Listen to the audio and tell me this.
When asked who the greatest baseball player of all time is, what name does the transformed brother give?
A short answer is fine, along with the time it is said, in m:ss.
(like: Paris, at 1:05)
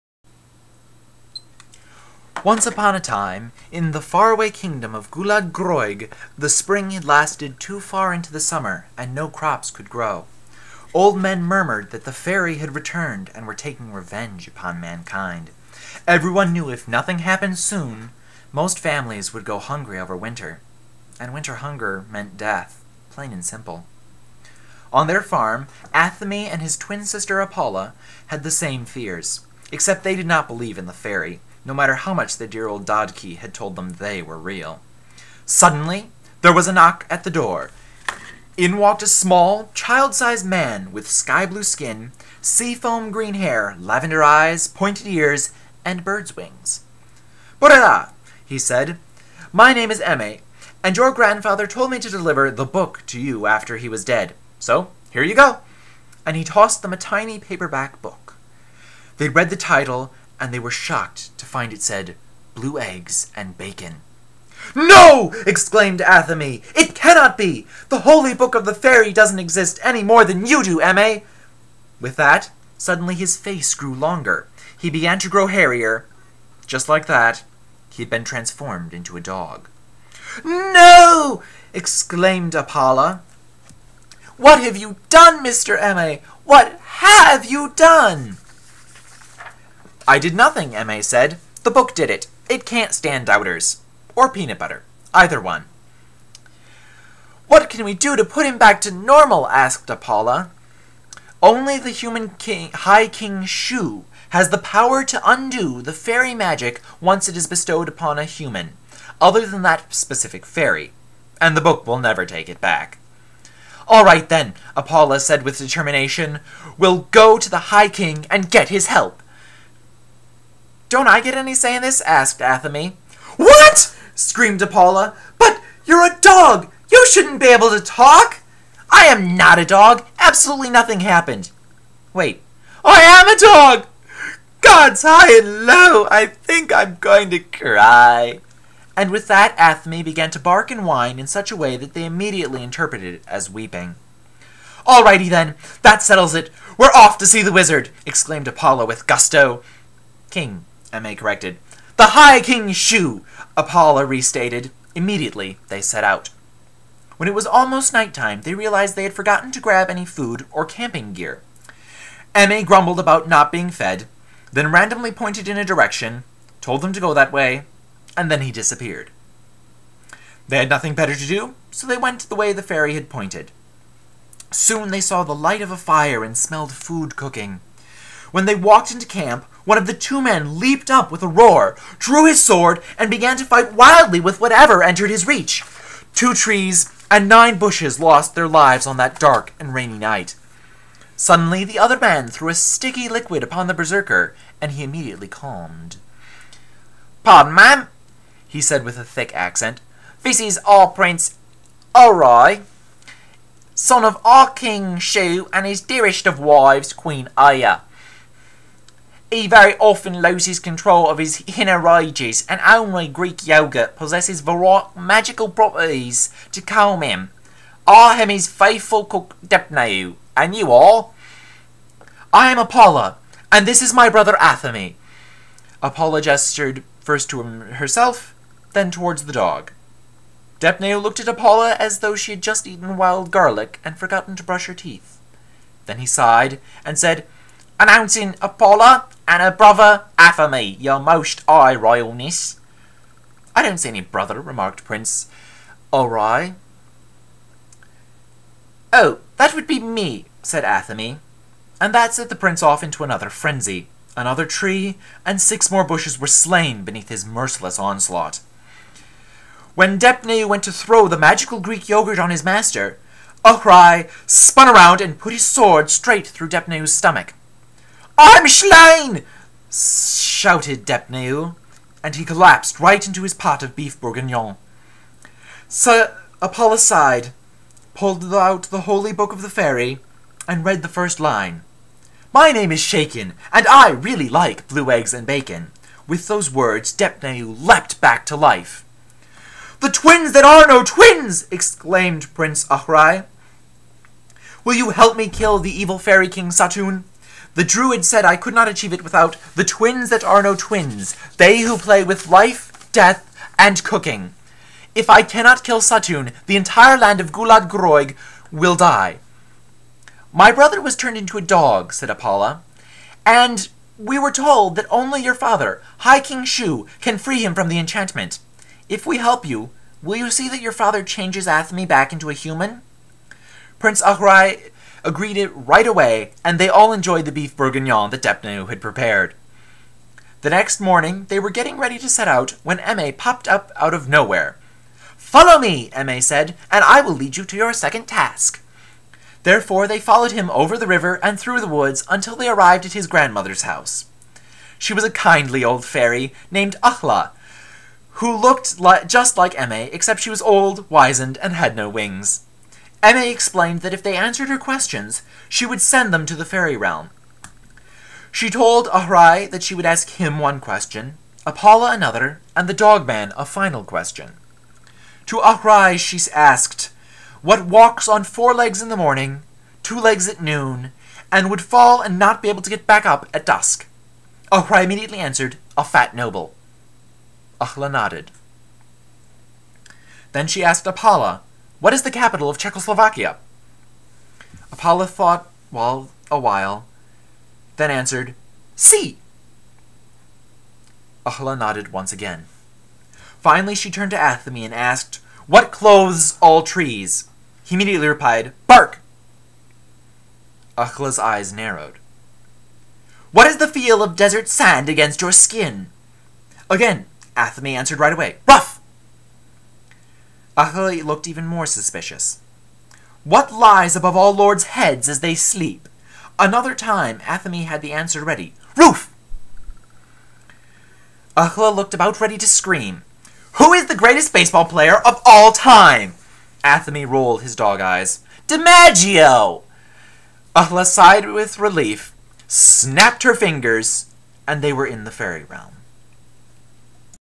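DiMaggio, at 7:08.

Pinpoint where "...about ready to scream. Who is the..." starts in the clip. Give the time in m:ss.
7:01.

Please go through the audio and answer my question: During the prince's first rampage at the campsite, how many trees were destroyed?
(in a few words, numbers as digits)
2.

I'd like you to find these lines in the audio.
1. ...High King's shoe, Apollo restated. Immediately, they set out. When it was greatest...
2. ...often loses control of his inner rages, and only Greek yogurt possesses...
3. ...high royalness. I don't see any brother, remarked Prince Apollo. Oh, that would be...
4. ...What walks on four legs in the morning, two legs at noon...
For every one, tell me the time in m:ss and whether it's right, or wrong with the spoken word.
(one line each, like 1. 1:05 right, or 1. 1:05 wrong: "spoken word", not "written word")
1. 2:32 wrong: "almost", not "greatest"
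2. 3:29 right
3. 4:01 wrong: "Ori", not "Apollo"
4. 6:07 right.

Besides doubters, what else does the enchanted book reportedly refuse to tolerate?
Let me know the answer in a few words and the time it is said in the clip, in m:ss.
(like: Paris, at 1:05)
Peanut butter, at 1:34.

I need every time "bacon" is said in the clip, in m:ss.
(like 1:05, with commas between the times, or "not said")
1:03, 4:45.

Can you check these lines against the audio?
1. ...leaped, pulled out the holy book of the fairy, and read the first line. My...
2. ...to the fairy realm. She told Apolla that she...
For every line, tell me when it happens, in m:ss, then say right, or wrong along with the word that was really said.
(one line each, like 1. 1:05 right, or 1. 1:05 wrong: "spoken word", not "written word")
1. 4:36 wrong: "sighed", not "leaped"
2. 5:56 wrong: "Ahrai", not "Apolla".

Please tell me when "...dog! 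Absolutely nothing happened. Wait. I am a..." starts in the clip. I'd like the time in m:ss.
2:09.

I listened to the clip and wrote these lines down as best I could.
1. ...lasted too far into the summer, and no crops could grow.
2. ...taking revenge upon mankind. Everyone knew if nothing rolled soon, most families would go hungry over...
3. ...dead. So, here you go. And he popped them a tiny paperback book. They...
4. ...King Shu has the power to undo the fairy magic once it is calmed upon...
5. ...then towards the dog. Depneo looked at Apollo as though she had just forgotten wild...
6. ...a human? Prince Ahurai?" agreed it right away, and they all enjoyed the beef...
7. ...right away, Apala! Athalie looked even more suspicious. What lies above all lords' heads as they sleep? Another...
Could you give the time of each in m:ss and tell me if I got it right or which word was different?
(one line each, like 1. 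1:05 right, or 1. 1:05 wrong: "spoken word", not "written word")
1. 0:07 right
2. 0:13 wrong: "happened", not "rolled"
3. 0:54 wrong: "tossed", not "popped"
4. 1:43 wrong: "bestowed", not "calmed"
5. 3:48 wrong: "eaten", not "forgotten"
6. 5:22 right
7. 6:47 wrong: "Rough", not "Apala".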